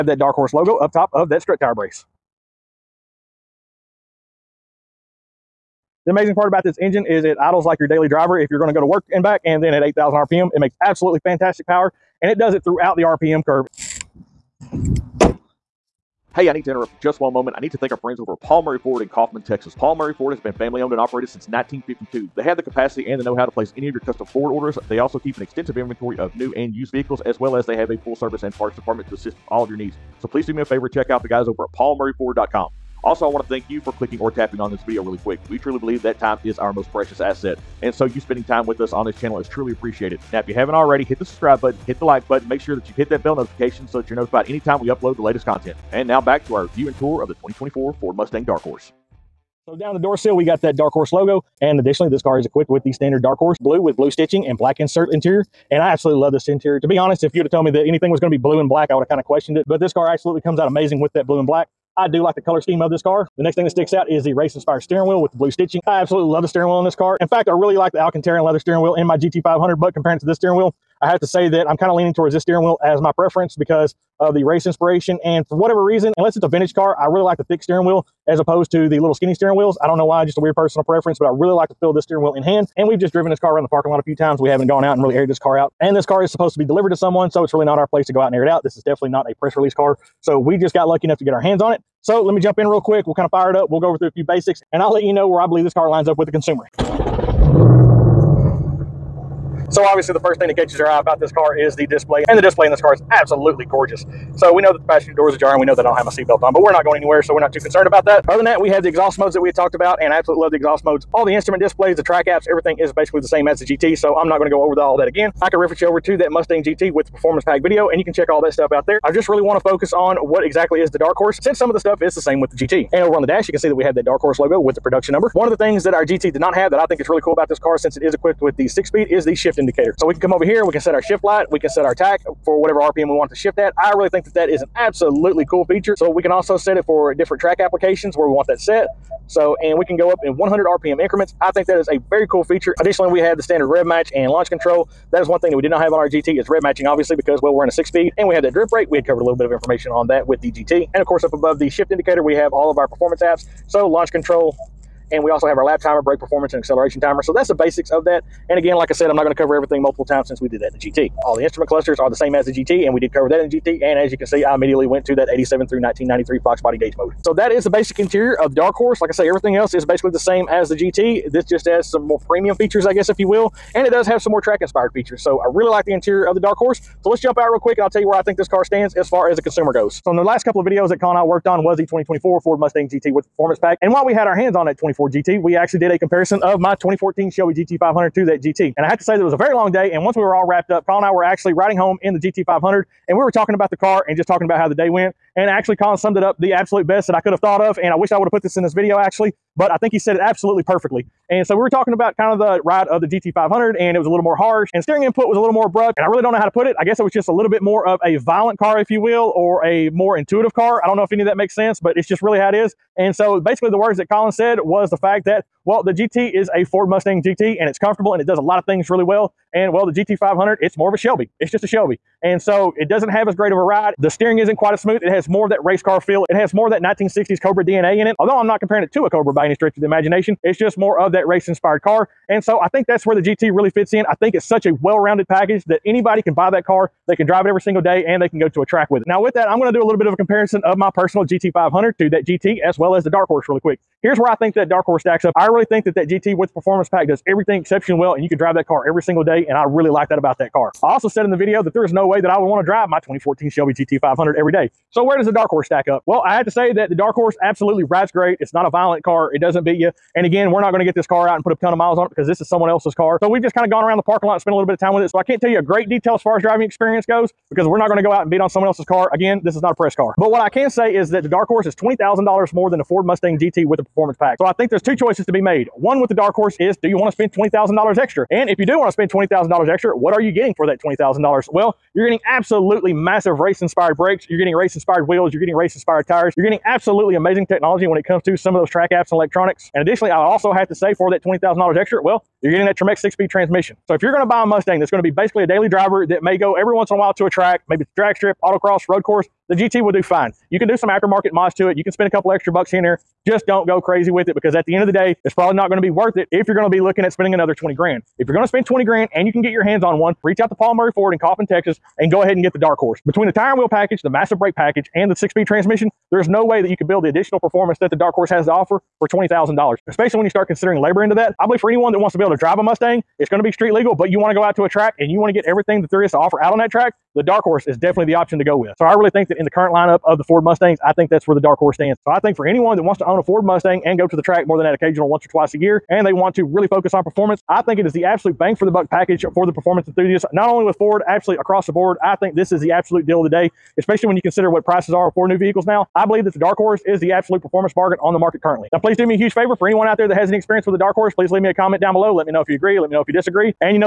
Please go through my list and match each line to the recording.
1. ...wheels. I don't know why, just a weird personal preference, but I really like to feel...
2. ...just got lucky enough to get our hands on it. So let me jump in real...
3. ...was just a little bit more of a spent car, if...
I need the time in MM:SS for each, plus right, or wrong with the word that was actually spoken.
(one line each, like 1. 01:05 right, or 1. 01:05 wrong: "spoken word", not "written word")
1. 01:19 right
2. 01:30 right
3. 03:27 wrong: "violent", not "spent".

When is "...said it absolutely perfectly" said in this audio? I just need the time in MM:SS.
03:19.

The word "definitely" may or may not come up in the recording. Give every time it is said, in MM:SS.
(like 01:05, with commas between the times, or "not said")
01:28, 05:27.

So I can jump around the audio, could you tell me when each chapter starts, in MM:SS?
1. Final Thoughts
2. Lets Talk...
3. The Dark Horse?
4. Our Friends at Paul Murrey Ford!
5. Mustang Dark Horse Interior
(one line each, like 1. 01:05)
1. 05:07
2. 03:00
3. 04:59
4. 00:16
5. 00:49.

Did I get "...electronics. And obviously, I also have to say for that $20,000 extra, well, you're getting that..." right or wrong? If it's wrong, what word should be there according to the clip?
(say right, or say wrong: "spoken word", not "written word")
wrong: "additionally", not "obviously".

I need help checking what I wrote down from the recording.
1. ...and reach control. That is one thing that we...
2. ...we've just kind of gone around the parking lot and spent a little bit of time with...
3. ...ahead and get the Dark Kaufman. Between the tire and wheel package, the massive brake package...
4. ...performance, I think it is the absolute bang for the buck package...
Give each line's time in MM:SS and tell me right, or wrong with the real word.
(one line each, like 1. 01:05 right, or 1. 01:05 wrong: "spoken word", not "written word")
1. 02:24 wrong: "launch", not "reach"
2. 04:23 right
3. 05:12 wrong: "Horse", not "Kaufman"
4. 05:37 right.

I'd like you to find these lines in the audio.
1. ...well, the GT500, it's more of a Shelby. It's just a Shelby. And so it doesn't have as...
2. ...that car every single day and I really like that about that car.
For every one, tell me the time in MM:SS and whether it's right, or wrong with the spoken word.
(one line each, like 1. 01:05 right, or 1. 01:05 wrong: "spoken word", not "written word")
1. 03:39 right
2. 04:08 right.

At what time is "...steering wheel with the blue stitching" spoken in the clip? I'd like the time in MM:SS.
01:04.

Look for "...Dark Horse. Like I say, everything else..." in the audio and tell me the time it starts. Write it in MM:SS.
02:48.